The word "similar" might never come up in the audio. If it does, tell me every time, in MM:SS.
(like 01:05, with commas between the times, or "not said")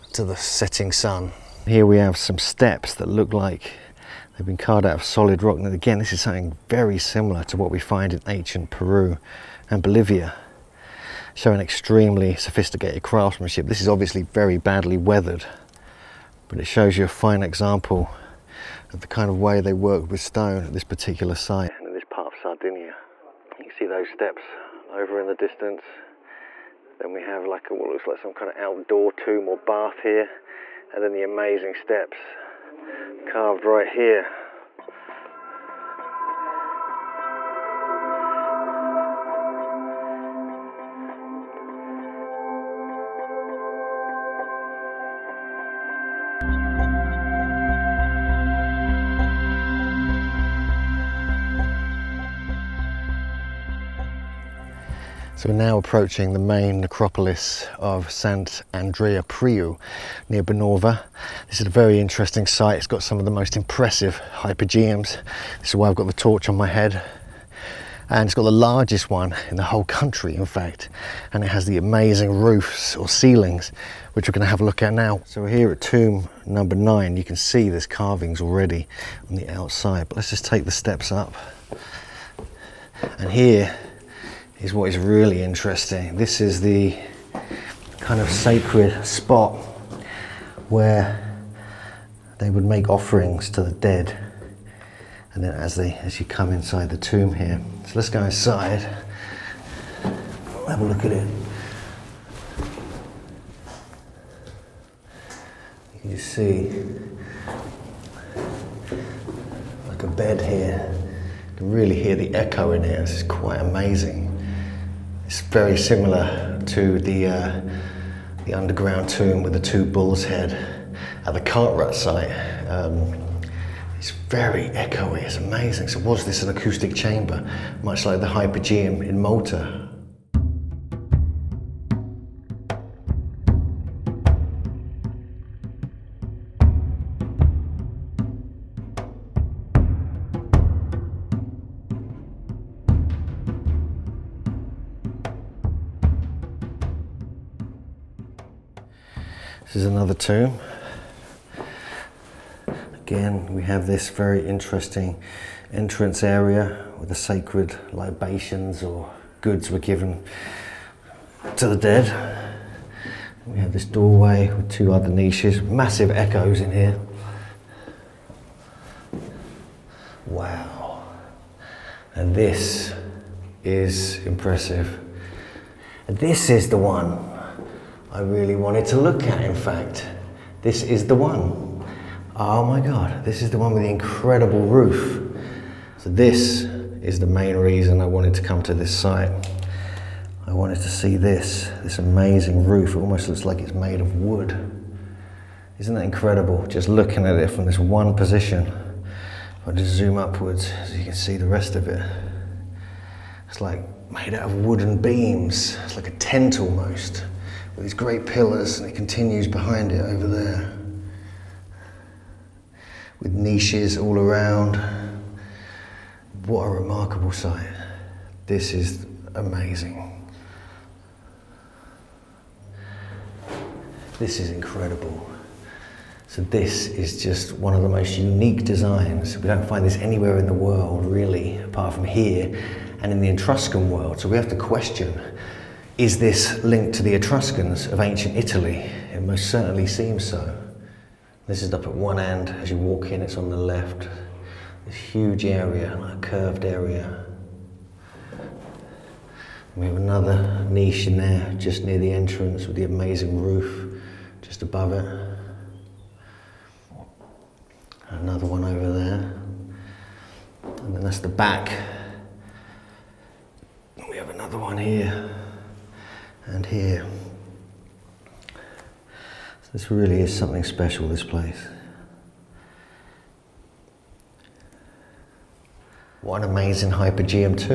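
00:06, 01:55.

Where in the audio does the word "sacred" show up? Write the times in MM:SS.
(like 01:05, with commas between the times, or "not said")
01:28, 02:37.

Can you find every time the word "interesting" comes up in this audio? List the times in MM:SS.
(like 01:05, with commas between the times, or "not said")
01:01, 01:25, 02:34.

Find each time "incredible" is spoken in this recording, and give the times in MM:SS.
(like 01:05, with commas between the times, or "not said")
03:03, 03:16, 03:44.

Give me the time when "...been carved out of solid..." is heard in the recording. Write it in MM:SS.
00:04.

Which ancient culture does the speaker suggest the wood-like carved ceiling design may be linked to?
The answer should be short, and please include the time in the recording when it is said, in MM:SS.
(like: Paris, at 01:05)
Etruscans, at 03:57.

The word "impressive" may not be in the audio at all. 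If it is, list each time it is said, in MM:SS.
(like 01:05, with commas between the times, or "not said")
01:03, 02:54.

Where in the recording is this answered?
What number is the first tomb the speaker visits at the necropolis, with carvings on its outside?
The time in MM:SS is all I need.
01:16.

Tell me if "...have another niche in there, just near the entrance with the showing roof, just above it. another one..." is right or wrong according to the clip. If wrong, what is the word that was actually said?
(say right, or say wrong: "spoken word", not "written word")
wrong: "amazing", not "showing".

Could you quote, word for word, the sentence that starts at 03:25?
It's like a tent almost with these great pillars, and it continues behind it over there with niches all around.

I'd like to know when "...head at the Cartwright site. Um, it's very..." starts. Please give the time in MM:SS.
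02:00.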